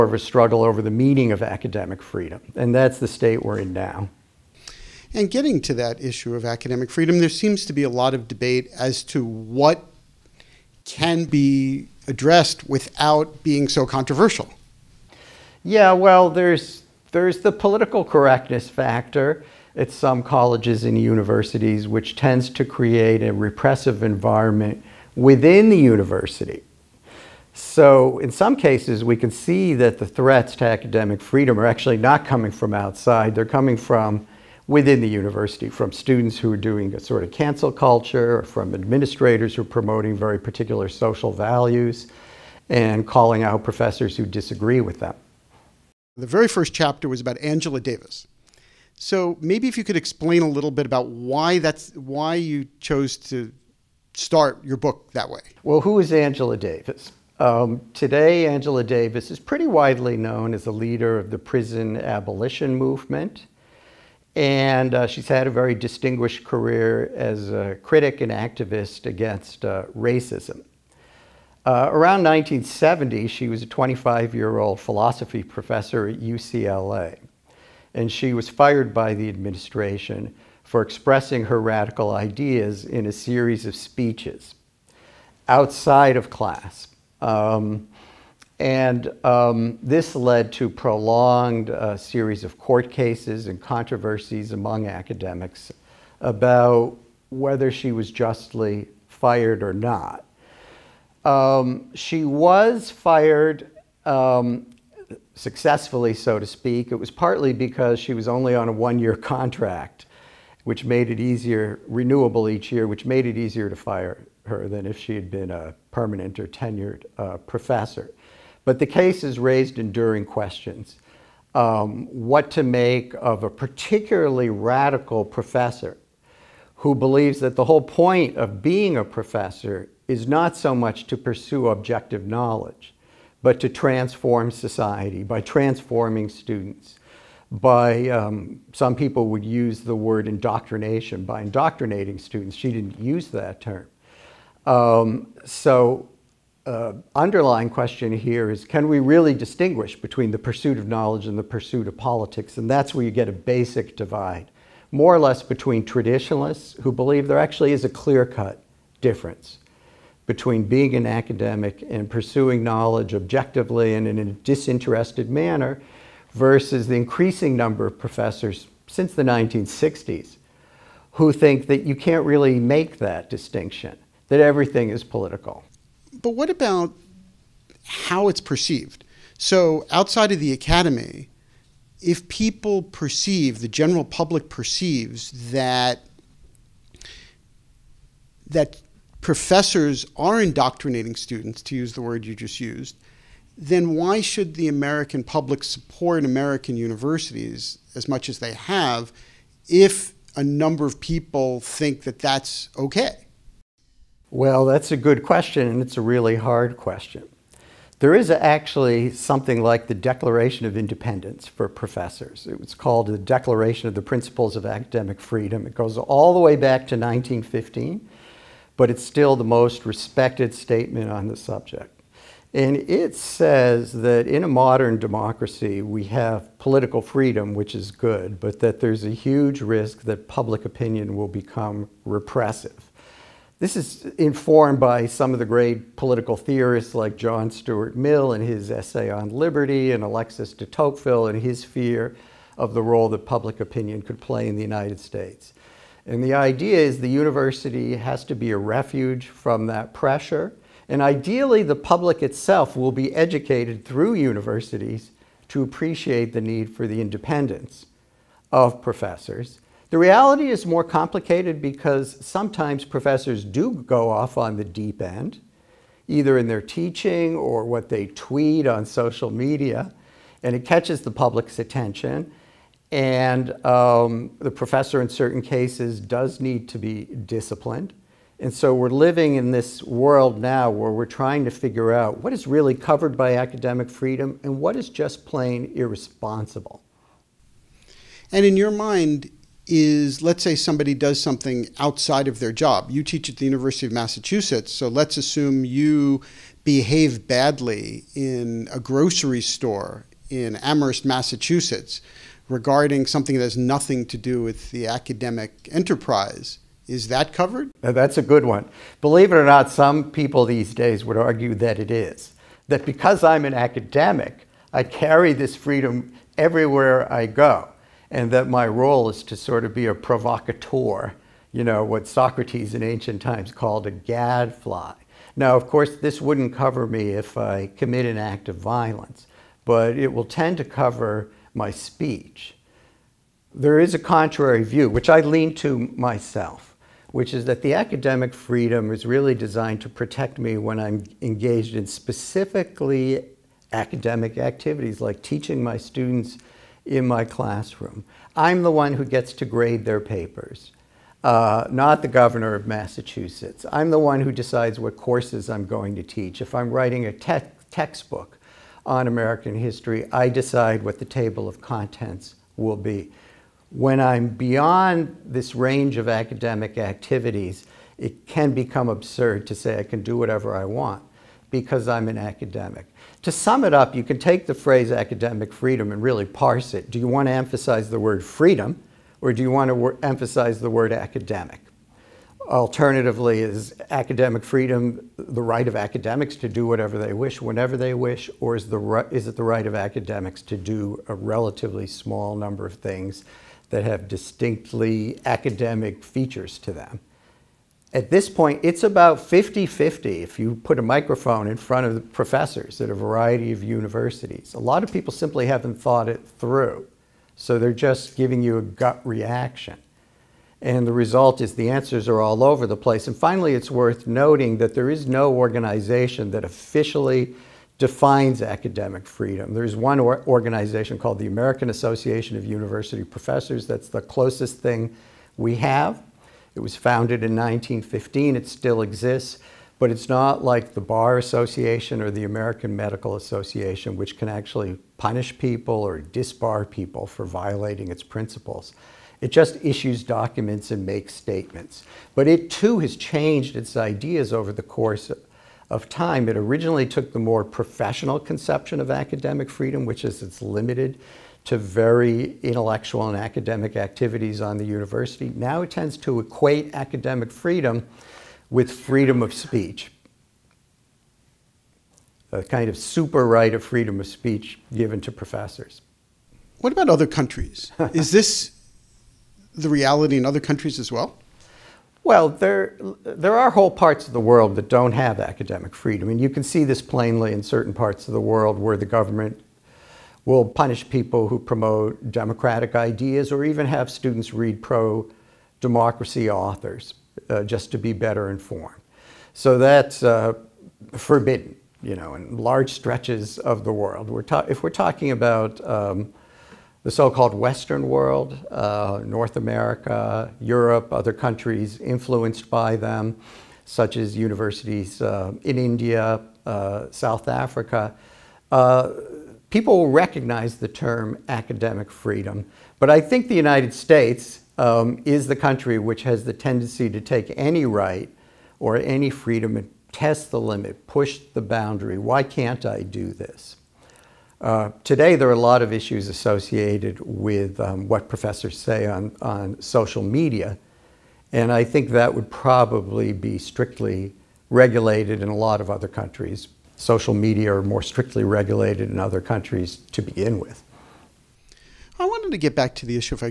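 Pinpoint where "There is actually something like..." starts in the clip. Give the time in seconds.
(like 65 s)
207 s.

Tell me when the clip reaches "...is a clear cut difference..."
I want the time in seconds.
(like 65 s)
157 s.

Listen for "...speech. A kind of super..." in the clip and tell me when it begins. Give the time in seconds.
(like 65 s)
459 s.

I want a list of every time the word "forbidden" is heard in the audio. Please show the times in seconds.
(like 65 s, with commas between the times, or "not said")
490 s.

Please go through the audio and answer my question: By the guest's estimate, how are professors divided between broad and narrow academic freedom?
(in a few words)
50 50.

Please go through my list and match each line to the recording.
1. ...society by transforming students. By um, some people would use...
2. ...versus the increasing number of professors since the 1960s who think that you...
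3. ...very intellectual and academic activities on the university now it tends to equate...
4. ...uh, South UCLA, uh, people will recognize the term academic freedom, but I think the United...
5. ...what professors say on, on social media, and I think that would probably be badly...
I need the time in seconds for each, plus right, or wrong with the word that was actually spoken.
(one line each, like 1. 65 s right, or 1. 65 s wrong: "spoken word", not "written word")
1. 134 s right
2. 166 s right
3. 451 s right
4. 506 s wrong: "Africa", not "UCLA"
5. 527 s wrong: "strictly", not "badly".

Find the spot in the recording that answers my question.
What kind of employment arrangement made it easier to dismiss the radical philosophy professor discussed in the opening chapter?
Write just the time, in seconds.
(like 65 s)
108 s.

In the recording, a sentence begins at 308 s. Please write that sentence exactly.
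Believe it or not, some people these days would argue that it is.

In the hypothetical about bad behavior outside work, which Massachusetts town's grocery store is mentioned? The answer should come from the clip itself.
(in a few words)
Amherst.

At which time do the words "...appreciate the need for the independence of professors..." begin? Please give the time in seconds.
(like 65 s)
255 s.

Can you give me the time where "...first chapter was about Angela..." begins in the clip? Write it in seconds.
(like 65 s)
46 s.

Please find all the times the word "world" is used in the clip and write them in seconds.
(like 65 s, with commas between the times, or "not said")
279 s, 474 s, 478 s, 493 s, 497 s.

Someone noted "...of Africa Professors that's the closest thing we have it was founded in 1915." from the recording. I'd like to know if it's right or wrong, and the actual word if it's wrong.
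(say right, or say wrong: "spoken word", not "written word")
wrong: "University", not "Africa".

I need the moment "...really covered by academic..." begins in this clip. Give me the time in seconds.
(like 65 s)
282 s.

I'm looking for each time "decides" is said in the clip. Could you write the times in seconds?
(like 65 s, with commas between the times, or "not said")
354 s, 360 s.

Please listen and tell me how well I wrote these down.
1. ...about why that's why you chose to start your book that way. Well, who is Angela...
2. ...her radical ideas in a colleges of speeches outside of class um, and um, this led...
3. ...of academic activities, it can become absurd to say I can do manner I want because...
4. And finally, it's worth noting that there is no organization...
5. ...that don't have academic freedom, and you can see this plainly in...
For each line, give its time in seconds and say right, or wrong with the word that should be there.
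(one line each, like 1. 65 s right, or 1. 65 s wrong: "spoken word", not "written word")
1. 50 s right
2. 81 s wrong: "series", not "colleges"
3. 365 s wrong: "whatever", not "manner"
4. 413 s right
5. 474 s right.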